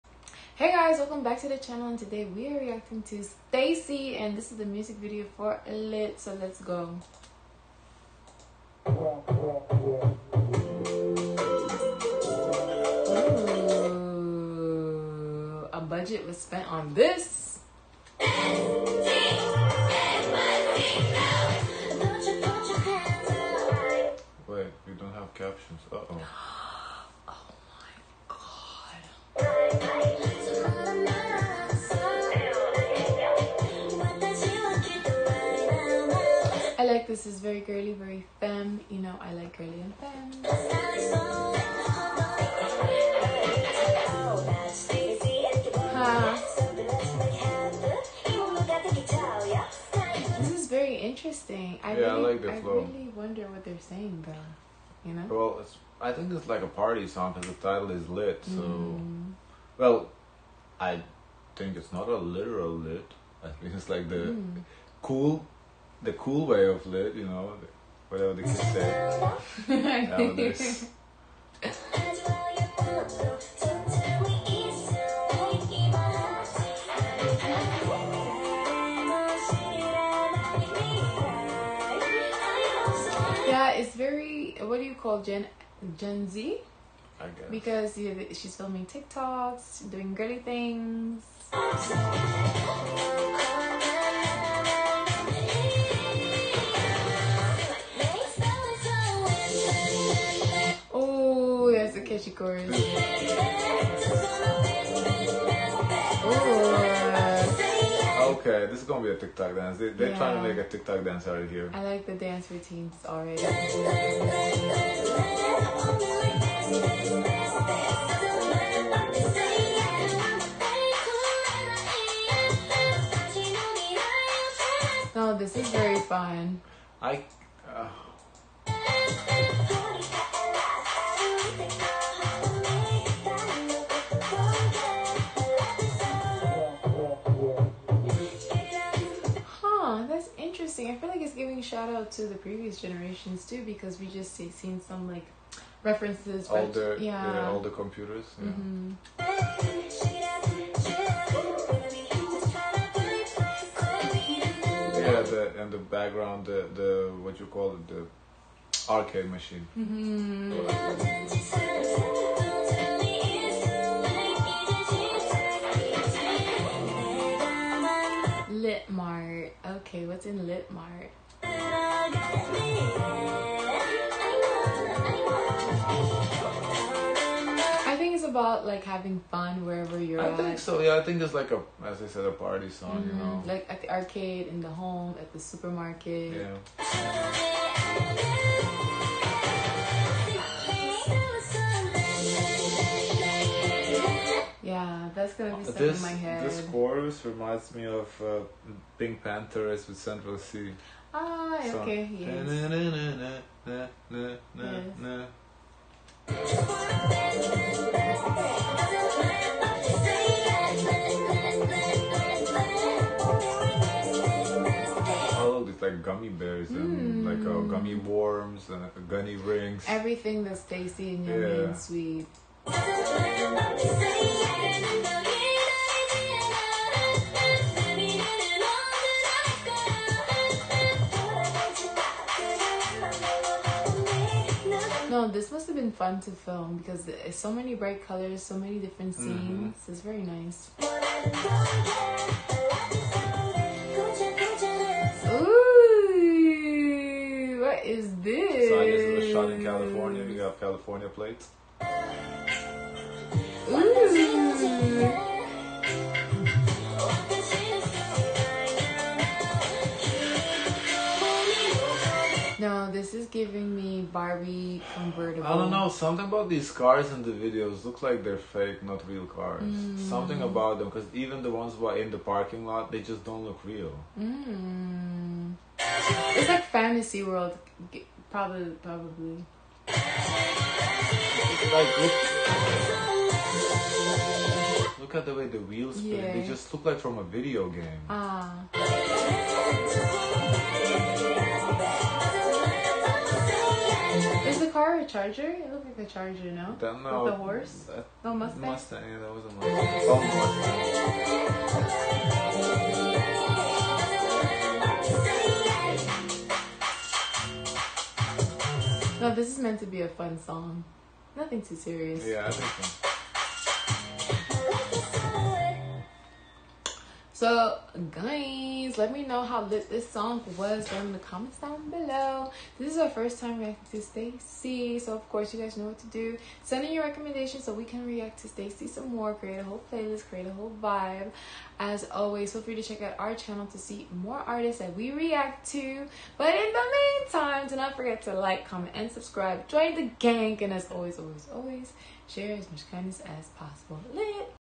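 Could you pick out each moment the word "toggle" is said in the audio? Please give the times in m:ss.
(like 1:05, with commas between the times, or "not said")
not said.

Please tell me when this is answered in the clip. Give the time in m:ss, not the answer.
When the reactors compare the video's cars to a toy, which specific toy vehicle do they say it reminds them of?
4:24.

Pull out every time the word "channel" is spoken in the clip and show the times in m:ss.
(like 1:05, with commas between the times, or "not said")
0:01, 5:33.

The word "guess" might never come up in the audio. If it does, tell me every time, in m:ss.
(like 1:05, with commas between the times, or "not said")
1:27, 4:08.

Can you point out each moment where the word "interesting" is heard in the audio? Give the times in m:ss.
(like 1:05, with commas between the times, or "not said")
0:50, 2:20.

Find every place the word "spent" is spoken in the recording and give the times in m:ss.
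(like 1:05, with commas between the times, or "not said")
0:16.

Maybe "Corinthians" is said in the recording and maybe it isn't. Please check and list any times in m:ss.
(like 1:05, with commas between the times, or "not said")
not said.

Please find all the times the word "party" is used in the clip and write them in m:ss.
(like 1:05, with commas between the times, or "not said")
0:56, 3:02.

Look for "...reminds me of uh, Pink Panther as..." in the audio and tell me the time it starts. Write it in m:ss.
3:17.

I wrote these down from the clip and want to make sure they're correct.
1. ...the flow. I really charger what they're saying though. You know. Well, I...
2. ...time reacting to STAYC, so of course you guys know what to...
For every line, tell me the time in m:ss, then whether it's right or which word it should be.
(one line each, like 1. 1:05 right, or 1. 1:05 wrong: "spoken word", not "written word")
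1. 0:52 wrong: "wonder", not "charger"
2. 5:23 right.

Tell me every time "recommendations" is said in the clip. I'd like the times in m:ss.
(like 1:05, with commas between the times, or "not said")
5:27.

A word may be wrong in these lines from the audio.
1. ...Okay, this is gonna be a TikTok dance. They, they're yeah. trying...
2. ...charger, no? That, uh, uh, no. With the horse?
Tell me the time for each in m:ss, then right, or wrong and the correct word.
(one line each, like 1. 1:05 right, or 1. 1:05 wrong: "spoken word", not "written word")
1. 1:48 right
2. 4:56 right.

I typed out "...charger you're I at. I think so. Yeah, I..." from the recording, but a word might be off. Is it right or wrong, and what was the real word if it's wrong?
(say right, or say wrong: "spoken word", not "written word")
wrong: "wherever", not "charger".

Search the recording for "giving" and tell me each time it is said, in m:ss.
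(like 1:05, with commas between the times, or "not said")
2:21, 4:23.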